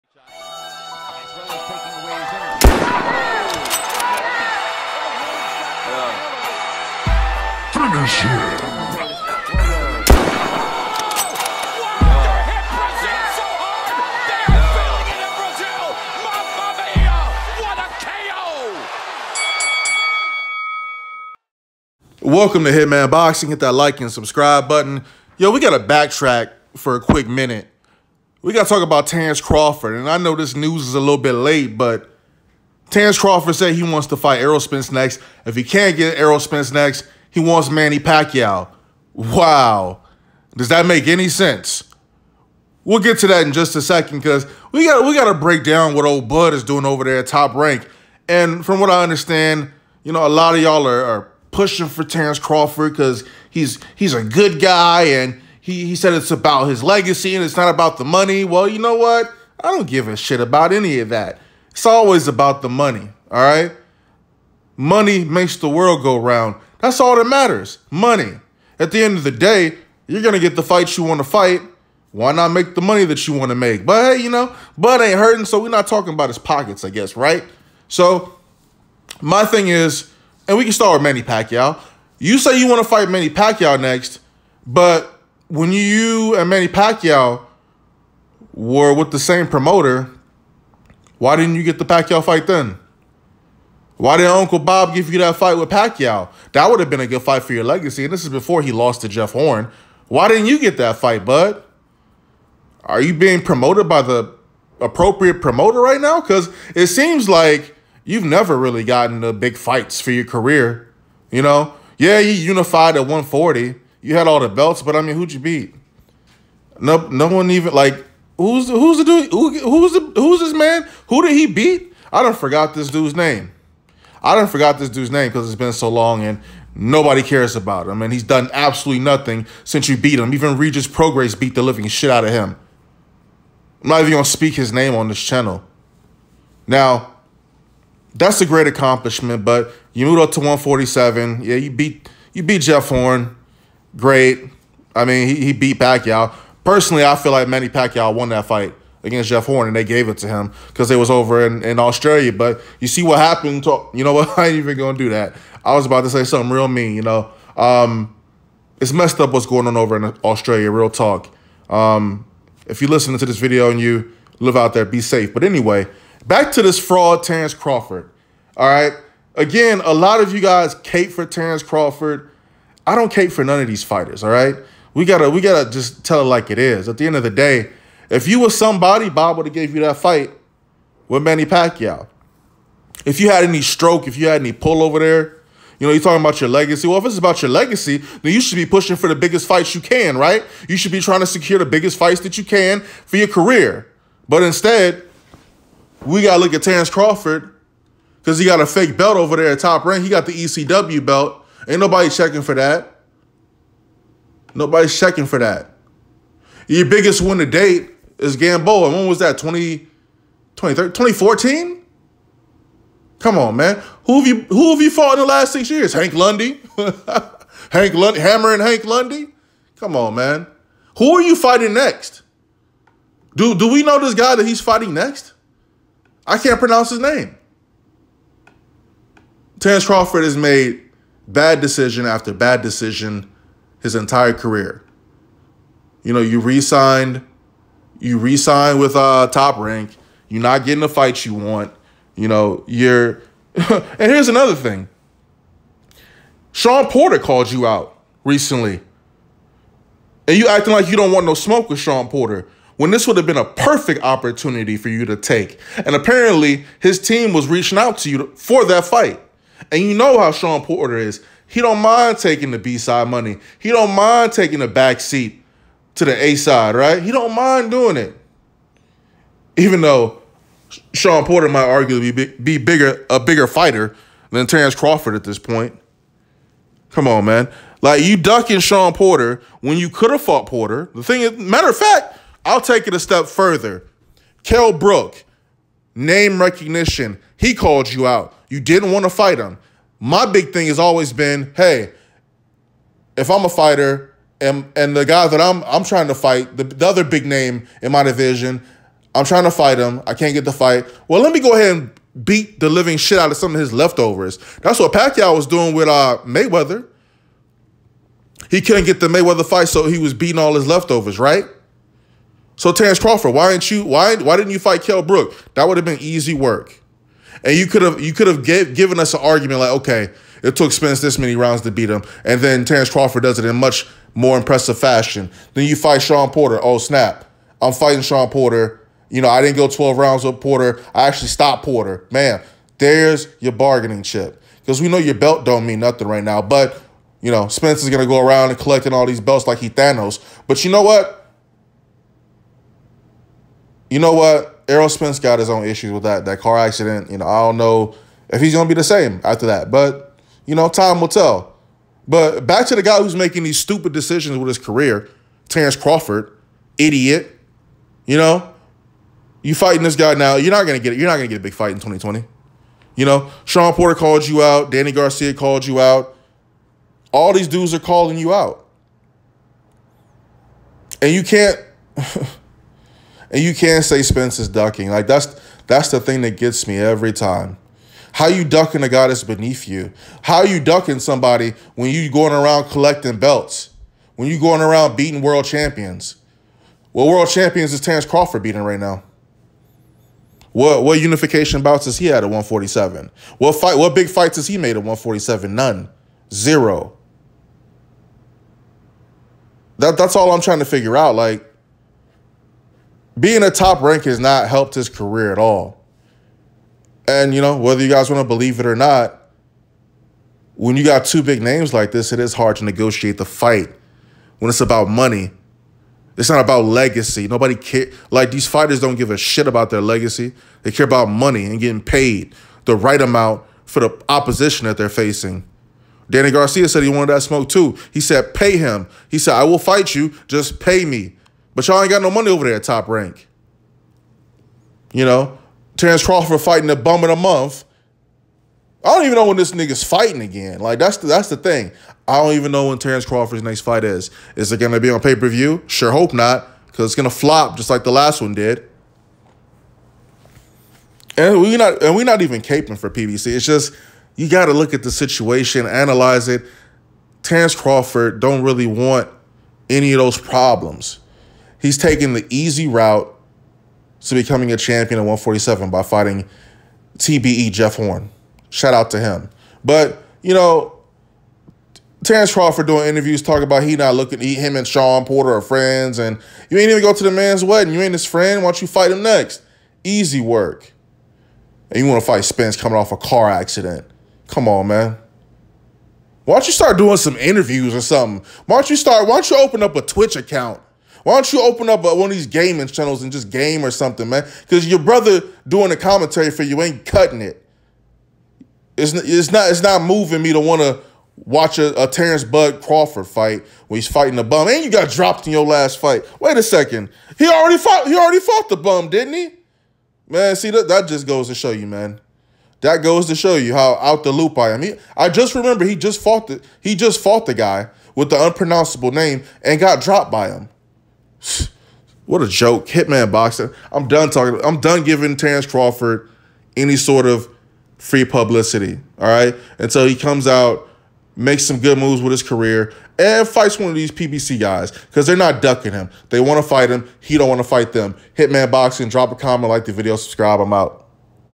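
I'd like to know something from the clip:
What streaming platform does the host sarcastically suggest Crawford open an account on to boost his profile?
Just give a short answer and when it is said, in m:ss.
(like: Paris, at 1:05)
Twitch, at 8:09.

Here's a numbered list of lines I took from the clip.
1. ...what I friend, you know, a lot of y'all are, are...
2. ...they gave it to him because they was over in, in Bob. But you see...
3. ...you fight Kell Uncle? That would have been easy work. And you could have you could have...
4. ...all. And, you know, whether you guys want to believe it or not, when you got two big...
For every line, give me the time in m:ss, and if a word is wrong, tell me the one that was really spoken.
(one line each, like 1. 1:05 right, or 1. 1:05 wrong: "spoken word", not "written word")
1. 0:48 wrong: "understand", not "friend"
2. 2:29 wrong: "Australia", not "Bob"
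3. 5:14 wrong: "Brook", not "Uncle"
4. 6:45 right.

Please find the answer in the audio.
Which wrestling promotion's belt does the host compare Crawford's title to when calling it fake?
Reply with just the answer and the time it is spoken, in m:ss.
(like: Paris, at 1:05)
ECW, at 3:20.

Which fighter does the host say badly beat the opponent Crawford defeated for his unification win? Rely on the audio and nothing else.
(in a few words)
Regis Prograis.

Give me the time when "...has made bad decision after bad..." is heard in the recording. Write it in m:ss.
3:50.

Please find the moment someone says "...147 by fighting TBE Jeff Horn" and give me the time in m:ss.
7:45.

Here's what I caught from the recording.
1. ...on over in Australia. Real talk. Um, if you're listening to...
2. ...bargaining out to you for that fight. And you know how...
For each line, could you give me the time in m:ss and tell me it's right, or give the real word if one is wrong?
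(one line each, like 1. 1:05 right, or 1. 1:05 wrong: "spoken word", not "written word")
1. 2:39 right
2. 4:17 wrong: "reaching", not "bargaining".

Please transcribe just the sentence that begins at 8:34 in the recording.
He, I just remember he just fought the he just fought the guy with the unpronounceable name and got dropped by him.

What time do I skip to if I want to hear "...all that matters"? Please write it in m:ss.
1:06.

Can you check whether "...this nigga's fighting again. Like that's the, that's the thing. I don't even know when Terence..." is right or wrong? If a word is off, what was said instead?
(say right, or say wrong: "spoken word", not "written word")
right.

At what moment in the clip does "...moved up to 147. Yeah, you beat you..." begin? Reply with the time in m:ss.
2:20.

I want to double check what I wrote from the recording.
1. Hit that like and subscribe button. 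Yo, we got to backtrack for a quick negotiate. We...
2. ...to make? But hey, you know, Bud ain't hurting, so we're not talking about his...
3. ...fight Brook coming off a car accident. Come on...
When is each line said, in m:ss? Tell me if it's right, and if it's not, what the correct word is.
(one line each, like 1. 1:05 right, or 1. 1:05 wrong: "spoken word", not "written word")
1. 0:23 wrong: "minute", not "negotiate"
2. 1:13 right
3. 8:02 wrong: "Spence", not "Brook".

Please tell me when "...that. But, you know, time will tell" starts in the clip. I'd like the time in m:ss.
5:49.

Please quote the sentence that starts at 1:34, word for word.
Why did Uncle Bob give you that fight with Pacquiao?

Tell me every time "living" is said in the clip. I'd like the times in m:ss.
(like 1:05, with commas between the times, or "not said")
2:11, 5:02.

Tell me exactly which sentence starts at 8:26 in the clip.
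Wait a second, he already fought he already fought the bum, didn't he?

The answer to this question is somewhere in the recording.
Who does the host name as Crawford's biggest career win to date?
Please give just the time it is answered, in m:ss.
3:28.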